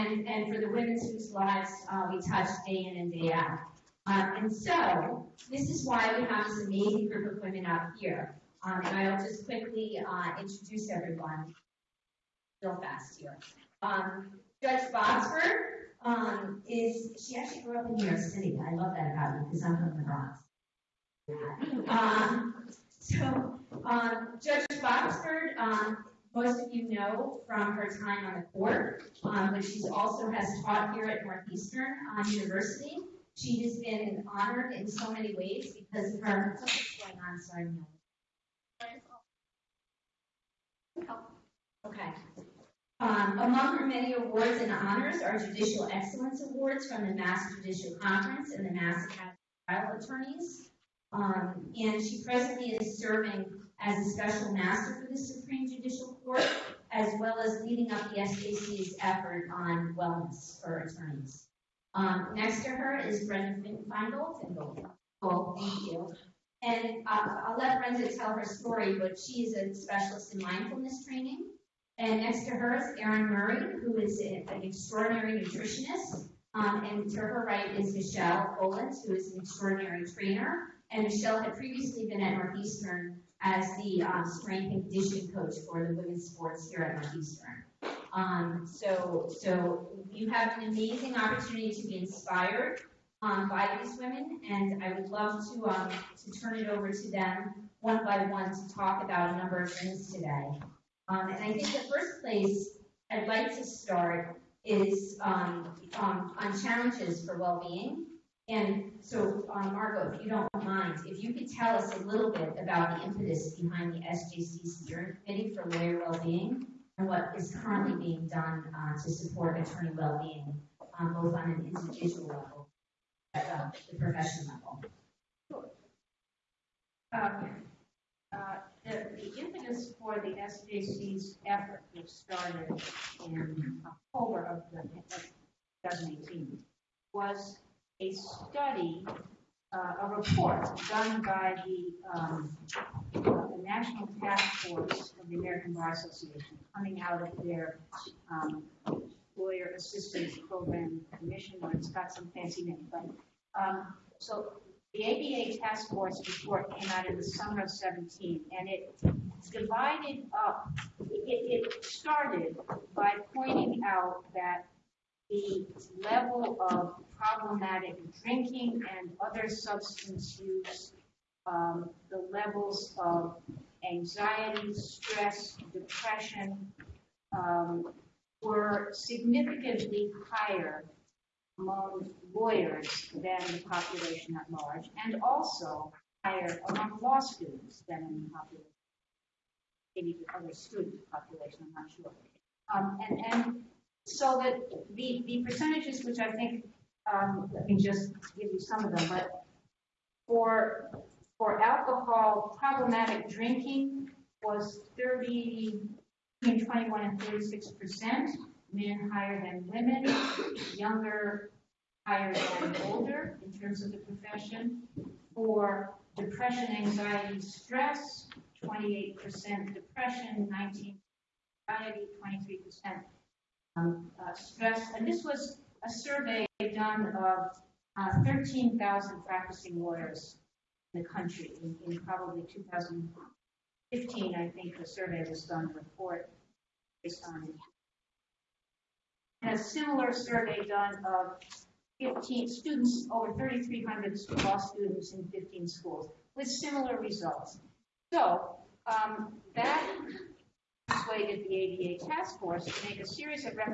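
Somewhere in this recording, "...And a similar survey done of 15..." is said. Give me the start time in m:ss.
3:59.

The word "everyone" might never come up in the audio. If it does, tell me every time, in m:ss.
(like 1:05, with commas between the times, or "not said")
0:10.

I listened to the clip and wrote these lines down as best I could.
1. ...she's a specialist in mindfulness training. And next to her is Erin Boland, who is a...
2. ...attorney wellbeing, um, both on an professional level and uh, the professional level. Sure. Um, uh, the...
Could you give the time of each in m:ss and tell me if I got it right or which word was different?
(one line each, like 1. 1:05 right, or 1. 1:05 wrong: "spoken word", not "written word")
1. 1:09 wrong: "Murray", not "Boland"
2. 1:59 wrong: "individual", not "professional".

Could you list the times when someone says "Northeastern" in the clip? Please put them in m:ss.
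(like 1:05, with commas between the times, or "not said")
0:31, 1:22, 1:27.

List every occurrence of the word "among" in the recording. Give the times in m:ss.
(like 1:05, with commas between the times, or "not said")
0:43, 3:01, 3:06.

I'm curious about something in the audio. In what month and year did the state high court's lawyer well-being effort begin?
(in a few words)
October 2018.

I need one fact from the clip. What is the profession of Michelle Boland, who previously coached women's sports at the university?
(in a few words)
trainer.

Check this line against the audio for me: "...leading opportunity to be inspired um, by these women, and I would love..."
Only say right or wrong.
wrong.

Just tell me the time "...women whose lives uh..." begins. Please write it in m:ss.
0:00.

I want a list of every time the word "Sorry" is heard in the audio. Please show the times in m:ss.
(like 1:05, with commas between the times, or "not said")
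0:37.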